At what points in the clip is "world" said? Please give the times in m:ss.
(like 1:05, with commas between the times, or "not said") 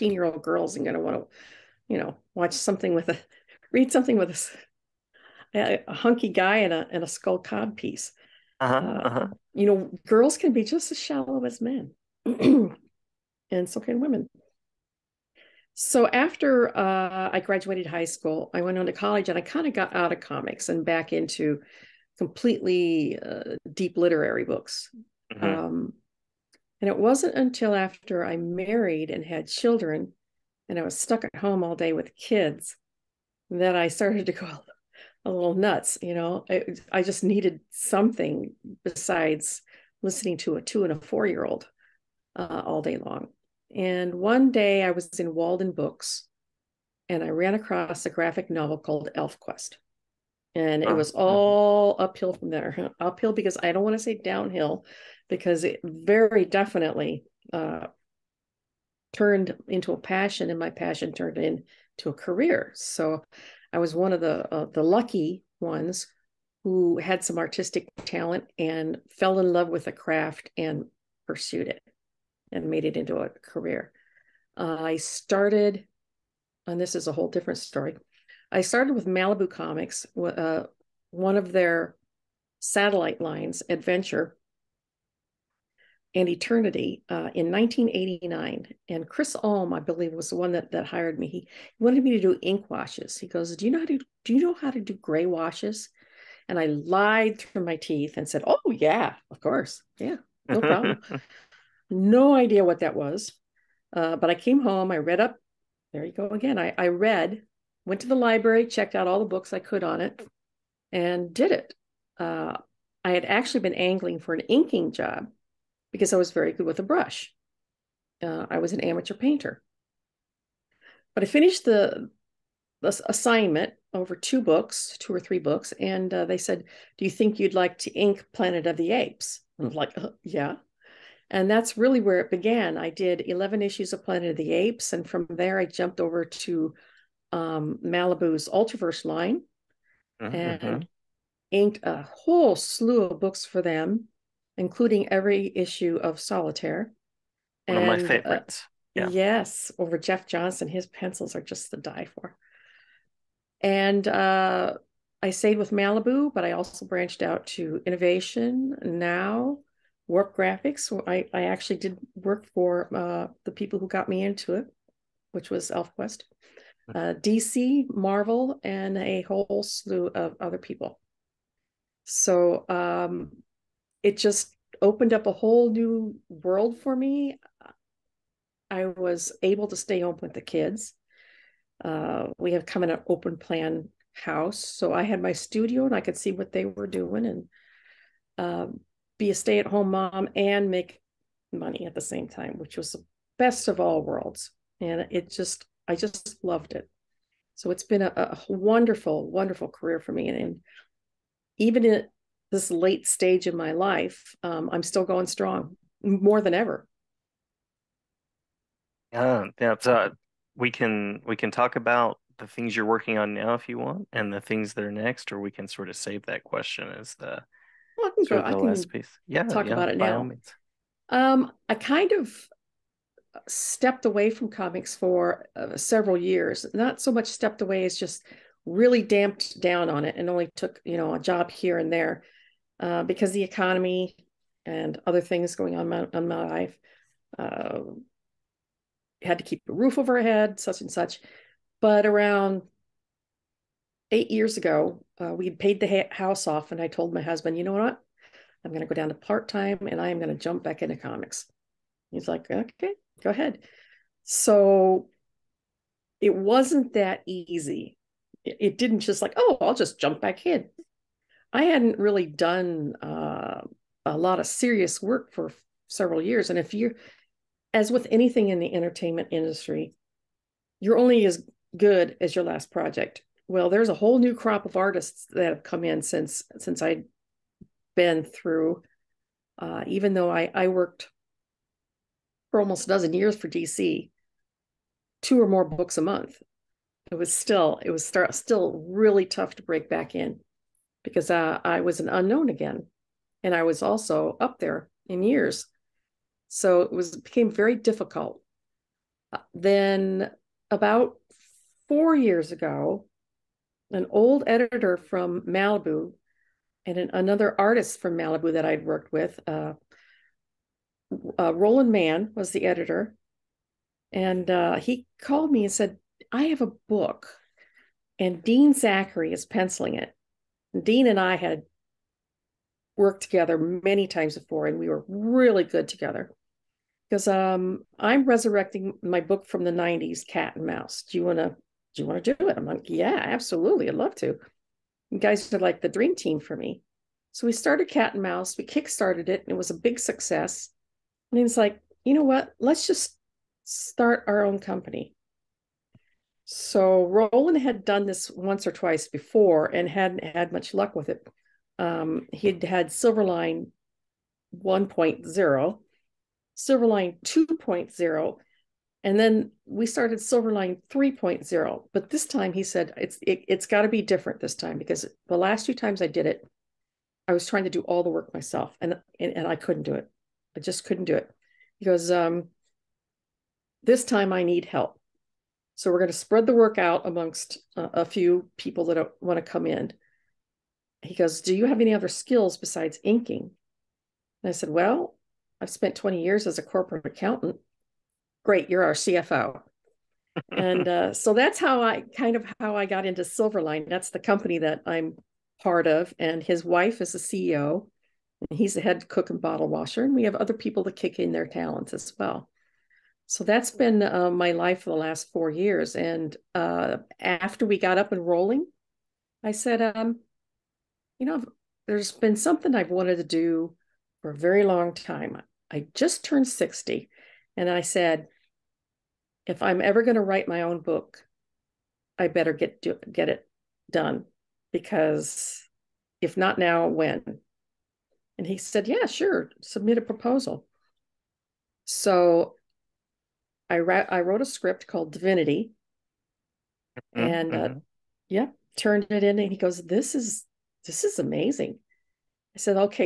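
2:56, 3:14.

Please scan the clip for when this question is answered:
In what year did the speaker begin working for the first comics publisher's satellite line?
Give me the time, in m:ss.
1:27.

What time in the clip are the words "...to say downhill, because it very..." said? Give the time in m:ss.
0:53.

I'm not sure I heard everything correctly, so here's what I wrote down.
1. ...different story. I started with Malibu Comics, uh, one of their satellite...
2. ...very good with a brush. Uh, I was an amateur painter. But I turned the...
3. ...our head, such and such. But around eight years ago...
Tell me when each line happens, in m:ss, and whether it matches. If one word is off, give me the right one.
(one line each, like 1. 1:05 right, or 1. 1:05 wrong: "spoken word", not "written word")
1. 1:17 right
2. 1:56 wrong: "finished", not "turned"
3. 4:00 right.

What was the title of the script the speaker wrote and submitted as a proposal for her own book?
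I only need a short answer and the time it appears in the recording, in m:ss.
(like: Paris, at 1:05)
Divinity, at 7:15.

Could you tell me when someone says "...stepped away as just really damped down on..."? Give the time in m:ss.
3:47.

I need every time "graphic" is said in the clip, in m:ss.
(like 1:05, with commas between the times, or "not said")
0:48, 2:40.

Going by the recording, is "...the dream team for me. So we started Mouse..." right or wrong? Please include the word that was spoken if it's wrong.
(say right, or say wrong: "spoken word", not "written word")
wrong: "Cat", not "Mouse".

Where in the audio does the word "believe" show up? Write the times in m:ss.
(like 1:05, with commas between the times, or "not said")
1:29.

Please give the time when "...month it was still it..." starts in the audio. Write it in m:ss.
4:46.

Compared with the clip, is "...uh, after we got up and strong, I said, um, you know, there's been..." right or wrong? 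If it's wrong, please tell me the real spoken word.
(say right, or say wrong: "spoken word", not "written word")
wrong: "rolling", not "strong".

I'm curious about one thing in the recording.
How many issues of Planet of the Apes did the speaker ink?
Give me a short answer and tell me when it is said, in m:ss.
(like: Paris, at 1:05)
11, at 2:13.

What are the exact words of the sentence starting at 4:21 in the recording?
I hadn't really done uh, a lot of serious work for several years.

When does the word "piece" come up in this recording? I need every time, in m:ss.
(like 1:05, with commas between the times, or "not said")
0:07, 3:38.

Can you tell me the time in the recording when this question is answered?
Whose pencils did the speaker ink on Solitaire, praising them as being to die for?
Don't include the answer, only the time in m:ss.
2:29.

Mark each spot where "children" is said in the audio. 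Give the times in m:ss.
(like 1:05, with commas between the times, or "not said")
0:29.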